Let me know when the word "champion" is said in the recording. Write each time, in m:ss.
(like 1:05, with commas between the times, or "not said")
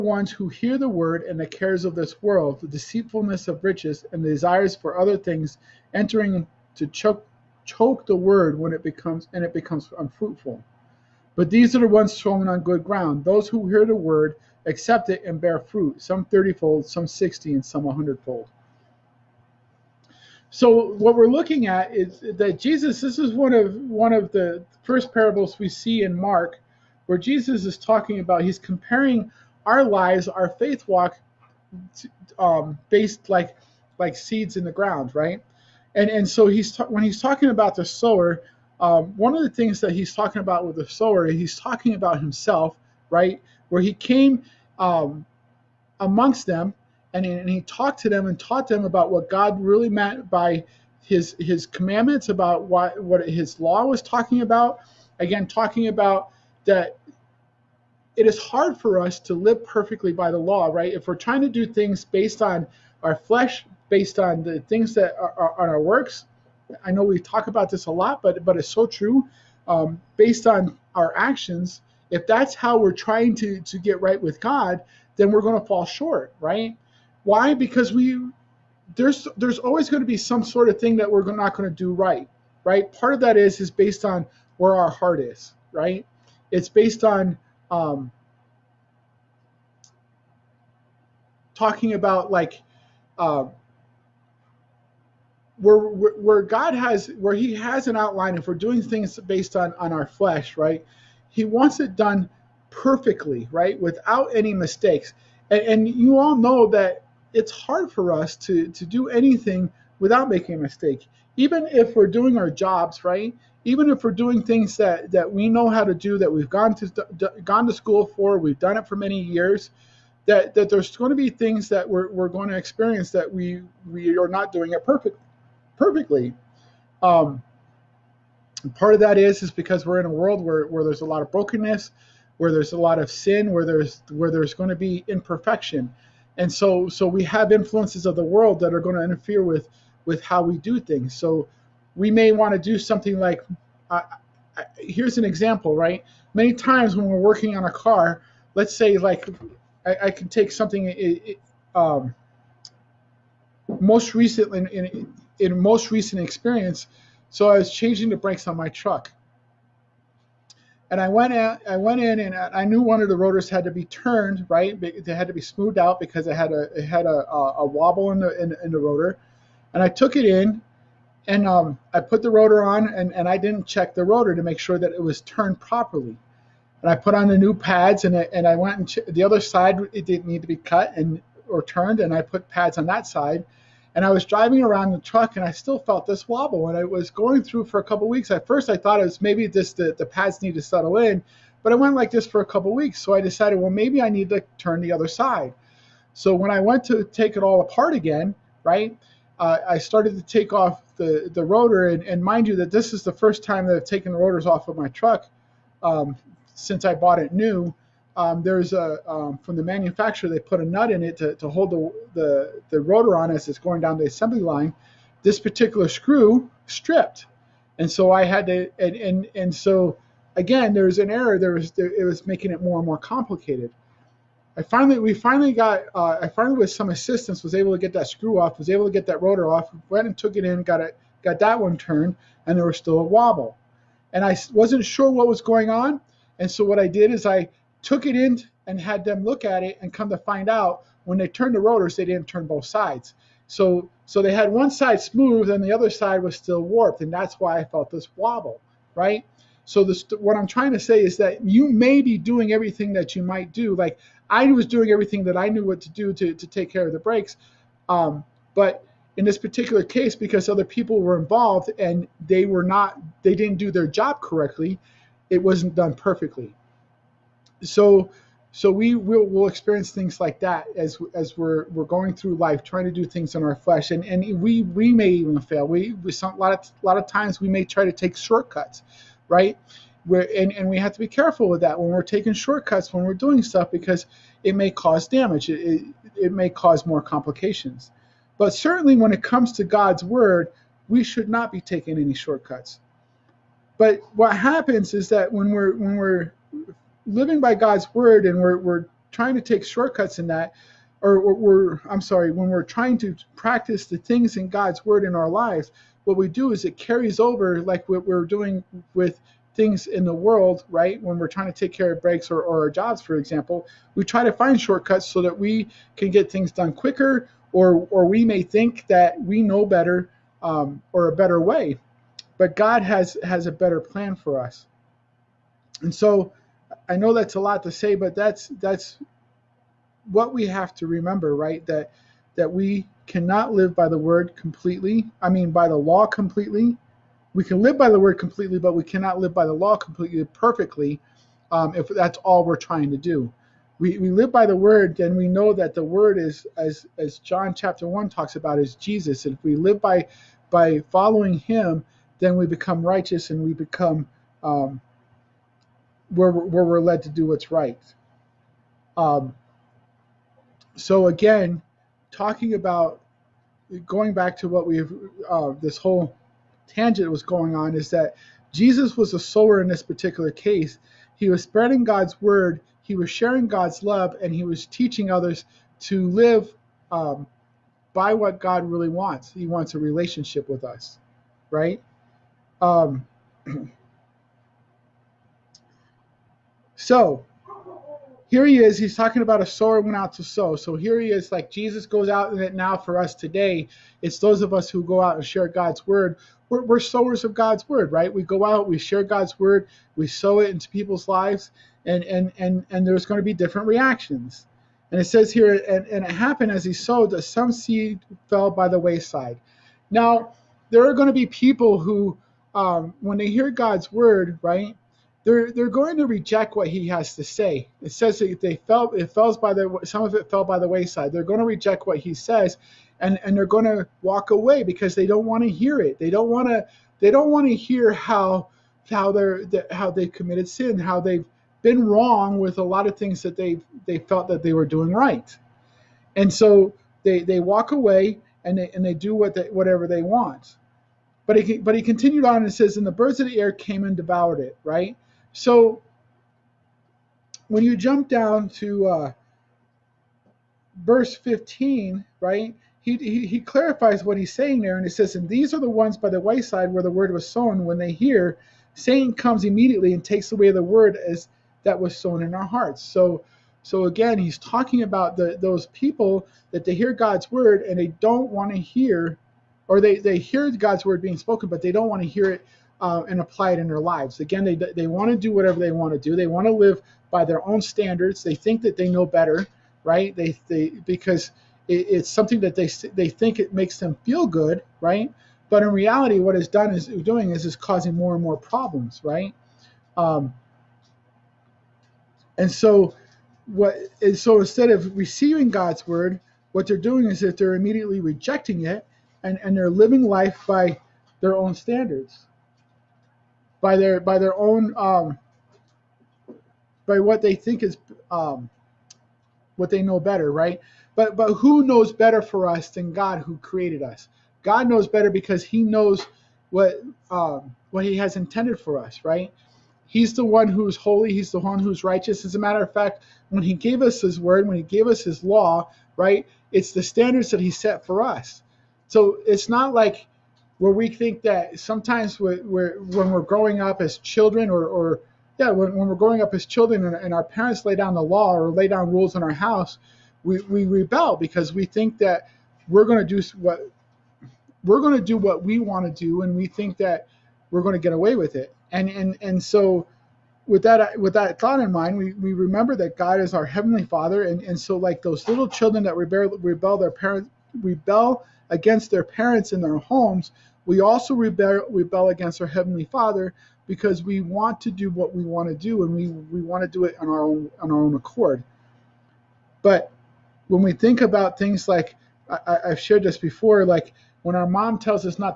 not said.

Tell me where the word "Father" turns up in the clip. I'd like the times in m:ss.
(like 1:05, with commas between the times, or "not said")
9:13, 9:22.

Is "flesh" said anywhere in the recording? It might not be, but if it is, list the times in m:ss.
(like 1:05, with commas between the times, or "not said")
1:03, 1:40, 4:33.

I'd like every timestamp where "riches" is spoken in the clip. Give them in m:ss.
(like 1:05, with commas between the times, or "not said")
0:03.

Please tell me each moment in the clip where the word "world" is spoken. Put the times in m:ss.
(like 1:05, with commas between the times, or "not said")
0:02, 2:10, 2:18, 5:10.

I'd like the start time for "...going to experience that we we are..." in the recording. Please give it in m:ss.
2:02.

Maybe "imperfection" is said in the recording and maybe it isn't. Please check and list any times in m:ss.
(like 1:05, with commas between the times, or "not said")
2:15.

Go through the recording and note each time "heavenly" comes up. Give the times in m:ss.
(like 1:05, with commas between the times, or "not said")
9:13, 9:22.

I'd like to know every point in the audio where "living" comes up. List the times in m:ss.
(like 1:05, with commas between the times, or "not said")
4:57, 8:19.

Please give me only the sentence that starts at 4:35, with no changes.
We, we some, a lot of a lot of times we may try to take shortcuts right?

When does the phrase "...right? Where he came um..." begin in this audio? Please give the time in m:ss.
0:43.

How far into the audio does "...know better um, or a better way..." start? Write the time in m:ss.
5:19.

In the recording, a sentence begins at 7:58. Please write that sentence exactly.
They think that they know better, right?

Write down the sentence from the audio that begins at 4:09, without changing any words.
So this, what I'm trying to say is that you may be doing everything that you might do.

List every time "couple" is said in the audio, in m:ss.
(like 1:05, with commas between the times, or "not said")
3:07, 3:12.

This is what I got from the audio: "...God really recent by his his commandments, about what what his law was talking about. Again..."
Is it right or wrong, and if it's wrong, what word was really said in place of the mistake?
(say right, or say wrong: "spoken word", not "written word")
wrong: "meant", not "recent".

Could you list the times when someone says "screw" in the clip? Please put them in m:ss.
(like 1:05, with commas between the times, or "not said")
3:35, 3:48.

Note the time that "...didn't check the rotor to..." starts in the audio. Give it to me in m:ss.
2:53.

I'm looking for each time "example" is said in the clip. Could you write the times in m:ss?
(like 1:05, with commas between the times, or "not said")
2:25, 5:13.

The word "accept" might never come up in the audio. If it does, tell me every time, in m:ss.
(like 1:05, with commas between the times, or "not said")
0:14.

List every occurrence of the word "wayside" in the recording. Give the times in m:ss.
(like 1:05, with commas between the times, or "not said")
6:48, 7:00, 7:36.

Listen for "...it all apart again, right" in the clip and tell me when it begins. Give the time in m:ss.
3:17.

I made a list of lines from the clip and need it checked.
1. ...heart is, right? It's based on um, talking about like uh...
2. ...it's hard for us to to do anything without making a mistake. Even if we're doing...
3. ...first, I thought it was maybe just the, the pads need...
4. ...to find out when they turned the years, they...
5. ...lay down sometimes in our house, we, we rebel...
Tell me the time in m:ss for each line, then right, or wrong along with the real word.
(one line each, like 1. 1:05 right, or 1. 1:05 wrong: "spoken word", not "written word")
1. 1:24 right
2. 1:47 right
3. 3:08 right
4. 4:00 wrong: "rotors", not "years"
5. 8:58 wrong: "rules", not "sometimes".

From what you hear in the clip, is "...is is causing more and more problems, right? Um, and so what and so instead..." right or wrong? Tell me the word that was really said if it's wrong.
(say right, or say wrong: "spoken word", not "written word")
right.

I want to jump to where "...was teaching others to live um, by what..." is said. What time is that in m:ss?
6:14.